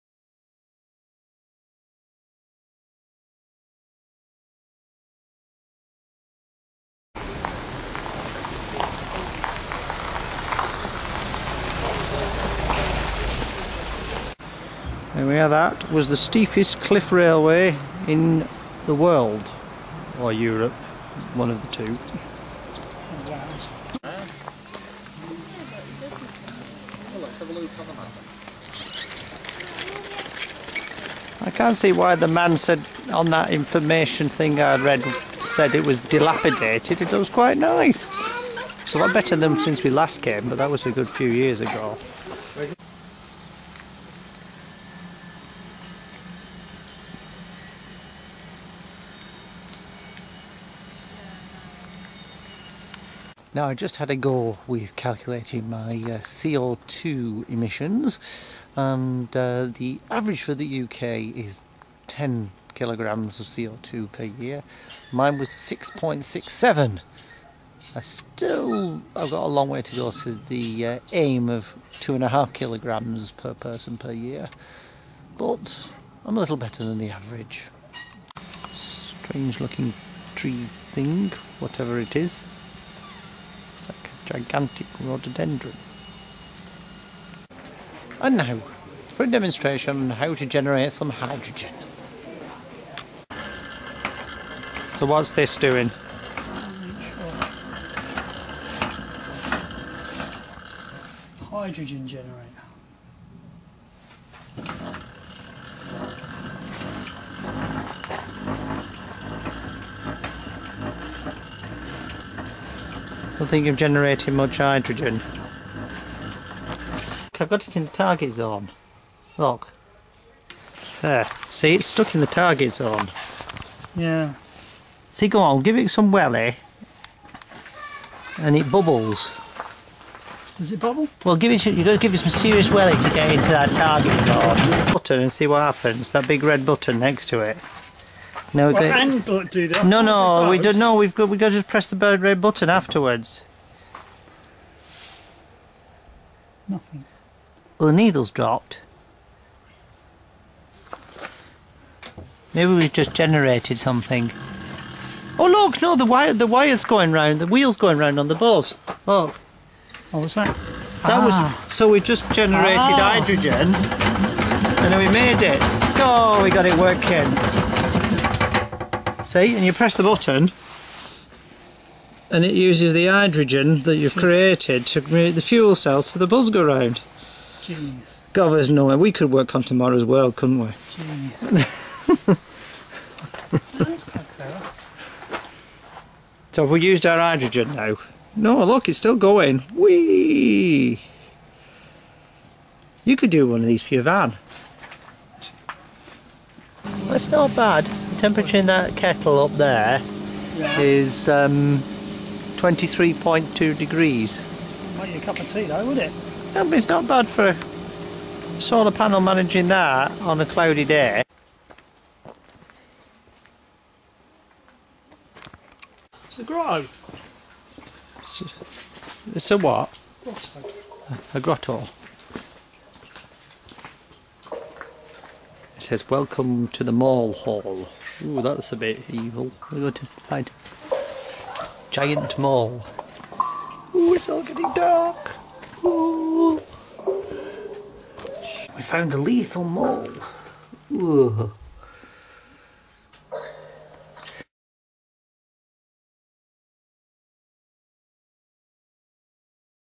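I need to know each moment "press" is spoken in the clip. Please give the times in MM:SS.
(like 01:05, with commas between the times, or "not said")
02:21, 02:49.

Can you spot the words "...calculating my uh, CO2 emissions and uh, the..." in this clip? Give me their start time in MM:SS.
00:54.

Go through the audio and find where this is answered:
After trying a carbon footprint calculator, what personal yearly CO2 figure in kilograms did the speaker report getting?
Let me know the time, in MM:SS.
01:05.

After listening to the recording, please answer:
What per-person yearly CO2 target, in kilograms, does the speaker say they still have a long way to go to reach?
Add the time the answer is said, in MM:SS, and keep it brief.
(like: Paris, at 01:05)
2.5, at 01:11.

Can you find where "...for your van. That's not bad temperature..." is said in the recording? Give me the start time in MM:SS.
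03:13.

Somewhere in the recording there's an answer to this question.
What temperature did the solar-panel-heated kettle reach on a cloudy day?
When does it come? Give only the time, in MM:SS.
03:22.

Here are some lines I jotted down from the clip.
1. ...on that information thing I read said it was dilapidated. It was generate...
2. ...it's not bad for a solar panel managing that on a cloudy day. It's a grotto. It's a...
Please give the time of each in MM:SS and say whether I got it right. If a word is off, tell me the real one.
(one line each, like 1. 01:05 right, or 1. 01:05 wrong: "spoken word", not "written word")
1. 00:33 wrong: "quite", not "generate"
2. 03:26 right.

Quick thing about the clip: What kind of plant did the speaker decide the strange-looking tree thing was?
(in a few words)
Rhododendron.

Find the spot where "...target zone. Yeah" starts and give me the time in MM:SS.
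02:02.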